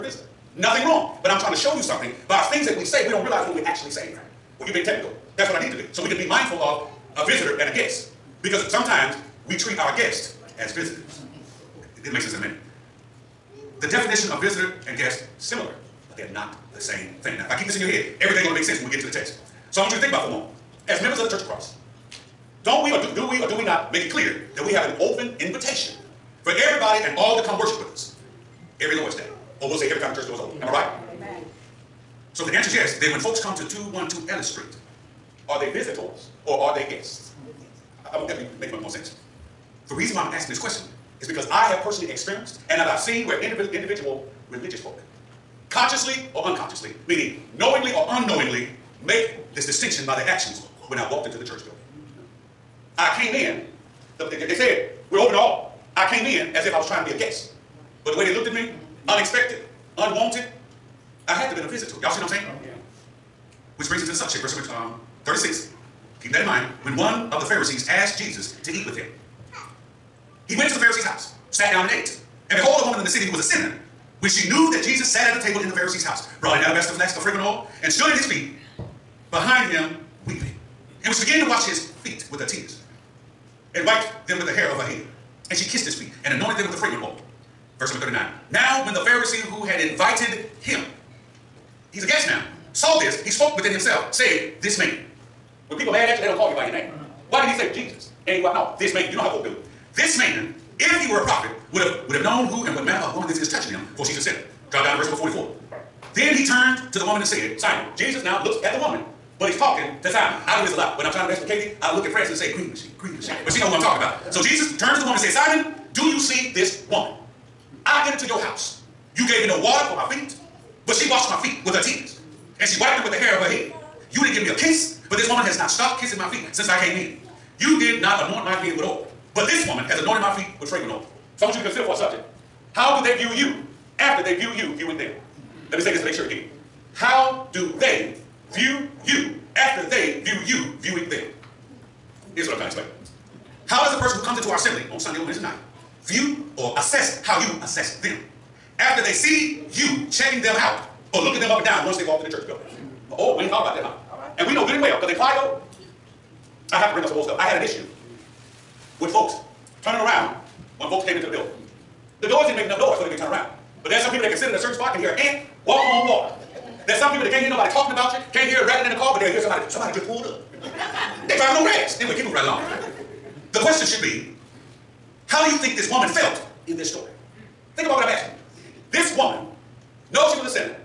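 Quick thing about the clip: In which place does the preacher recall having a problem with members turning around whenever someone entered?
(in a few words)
Clio.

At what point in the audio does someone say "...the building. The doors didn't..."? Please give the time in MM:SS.
02:41.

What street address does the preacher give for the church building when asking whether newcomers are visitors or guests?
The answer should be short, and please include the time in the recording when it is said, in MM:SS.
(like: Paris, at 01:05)
212 Ellis Street, at 00:33.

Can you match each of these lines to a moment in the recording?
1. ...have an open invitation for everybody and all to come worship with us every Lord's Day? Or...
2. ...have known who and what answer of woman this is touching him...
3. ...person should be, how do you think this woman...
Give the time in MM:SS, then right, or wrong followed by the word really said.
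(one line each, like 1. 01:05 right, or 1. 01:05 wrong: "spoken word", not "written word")
1. 00:24 right
2. 01:42 wrong: "manner", not "answer"
3. 02:53 wrong: "question", not "person".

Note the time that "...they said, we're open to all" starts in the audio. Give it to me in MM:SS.
00:54.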